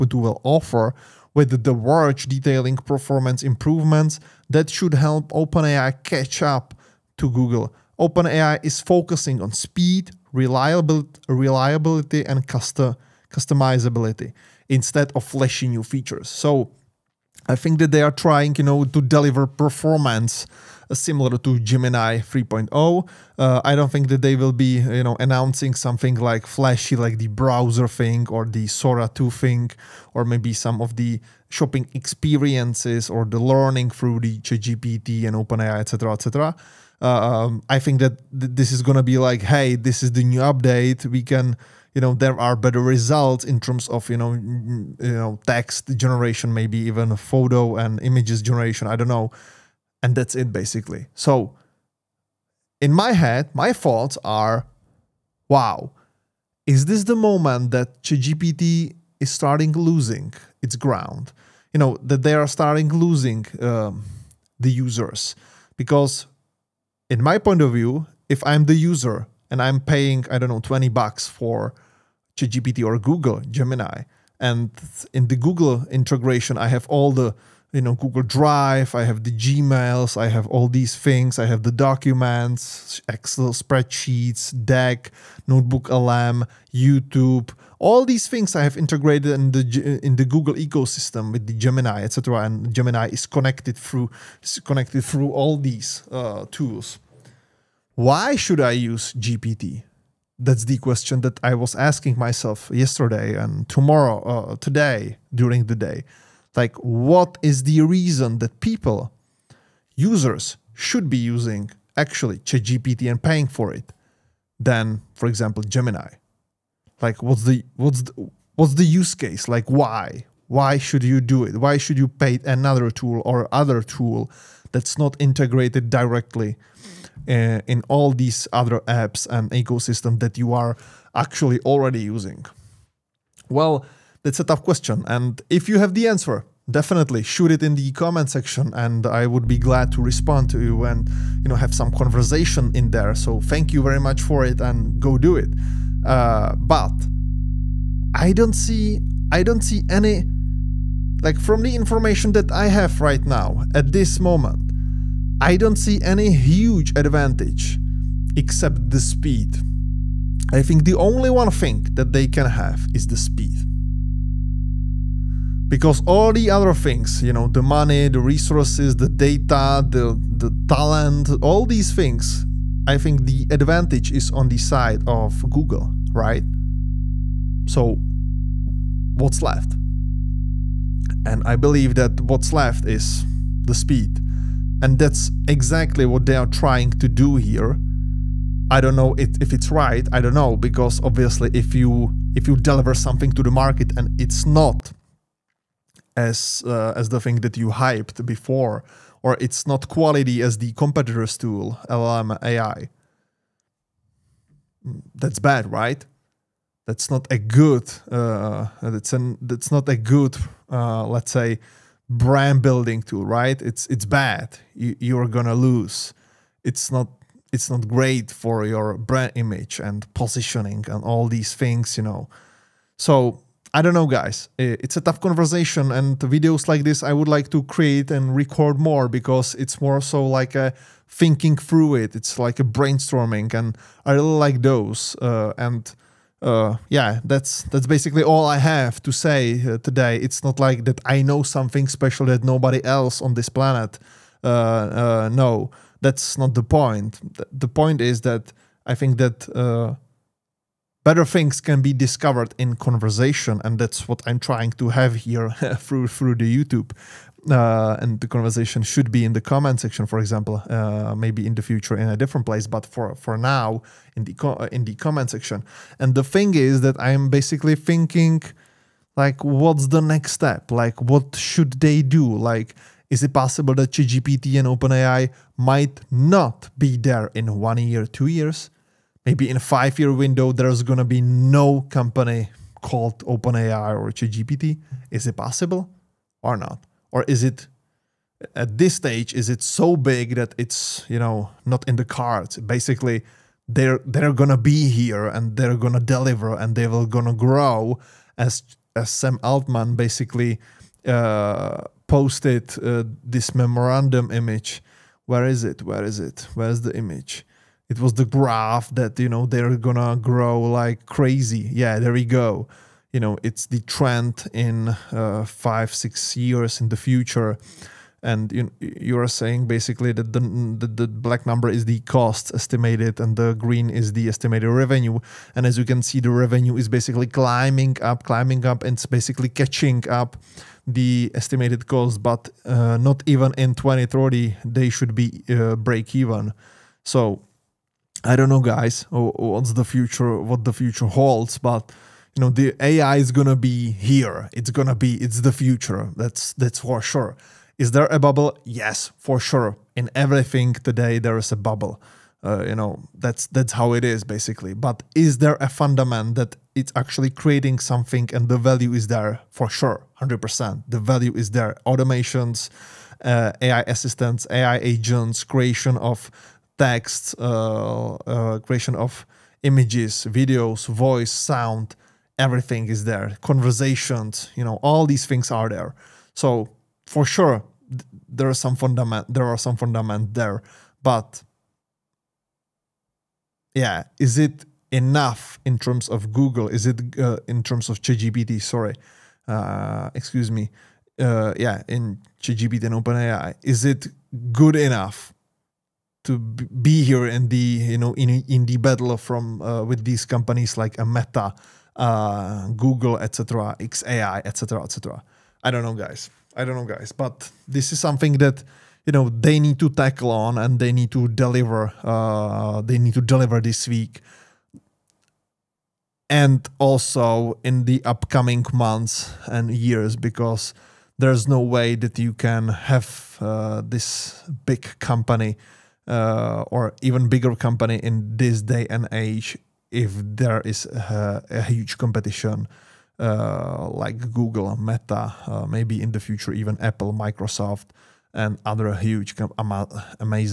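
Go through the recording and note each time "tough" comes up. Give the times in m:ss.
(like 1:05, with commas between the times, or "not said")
2:14, 3:44.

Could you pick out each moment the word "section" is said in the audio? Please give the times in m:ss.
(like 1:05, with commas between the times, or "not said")
2:18, 4:19, 4:25.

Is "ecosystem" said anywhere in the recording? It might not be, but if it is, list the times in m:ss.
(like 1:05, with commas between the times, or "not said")
1:30, 2:09.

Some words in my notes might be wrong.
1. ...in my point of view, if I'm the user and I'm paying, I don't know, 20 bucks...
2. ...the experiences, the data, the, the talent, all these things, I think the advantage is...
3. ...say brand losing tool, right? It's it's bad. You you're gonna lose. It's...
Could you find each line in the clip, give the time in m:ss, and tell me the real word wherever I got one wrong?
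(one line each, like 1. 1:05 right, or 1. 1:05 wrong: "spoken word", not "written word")
1. 1:07 right
2. 2:48 wrong: "resources", not "experiences"
3. 3:31 wrong: "building", not "losing".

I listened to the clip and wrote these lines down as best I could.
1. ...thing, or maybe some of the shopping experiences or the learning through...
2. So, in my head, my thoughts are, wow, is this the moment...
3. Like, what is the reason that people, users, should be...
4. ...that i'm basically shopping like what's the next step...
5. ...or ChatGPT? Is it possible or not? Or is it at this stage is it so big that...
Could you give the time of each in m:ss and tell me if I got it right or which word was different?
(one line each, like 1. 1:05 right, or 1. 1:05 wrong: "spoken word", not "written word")
1. 0:29 right
2. 0:51 right
3. 1:46 right
4. 4:26 wrong: "thinking", not "shopping"
5. 4:43 right.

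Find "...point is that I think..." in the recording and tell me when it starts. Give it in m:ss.
4:07.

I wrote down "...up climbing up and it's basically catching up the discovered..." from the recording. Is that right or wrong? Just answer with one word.
wrong.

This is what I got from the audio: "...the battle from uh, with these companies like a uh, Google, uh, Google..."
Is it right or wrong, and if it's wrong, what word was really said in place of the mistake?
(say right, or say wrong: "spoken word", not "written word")
wrong: "Meta", not "Google".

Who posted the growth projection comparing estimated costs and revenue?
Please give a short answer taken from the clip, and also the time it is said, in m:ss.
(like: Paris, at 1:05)
Sam Altman, at 4:59.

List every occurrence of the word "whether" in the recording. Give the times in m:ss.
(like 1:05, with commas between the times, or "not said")
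0:01.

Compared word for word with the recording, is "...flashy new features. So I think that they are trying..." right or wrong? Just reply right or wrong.
right.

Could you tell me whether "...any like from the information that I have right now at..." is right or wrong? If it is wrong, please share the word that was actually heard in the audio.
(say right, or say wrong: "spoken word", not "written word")
right.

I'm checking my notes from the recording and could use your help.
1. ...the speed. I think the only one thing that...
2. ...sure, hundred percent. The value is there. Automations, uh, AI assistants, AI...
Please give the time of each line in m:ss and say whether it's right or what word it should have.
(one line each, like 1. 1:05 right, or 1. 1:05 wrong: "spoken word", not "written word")
1. 2:38 right
2. 5:59 right.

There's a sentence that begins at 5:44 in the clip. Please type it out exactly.
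It's gonna be, it's the future.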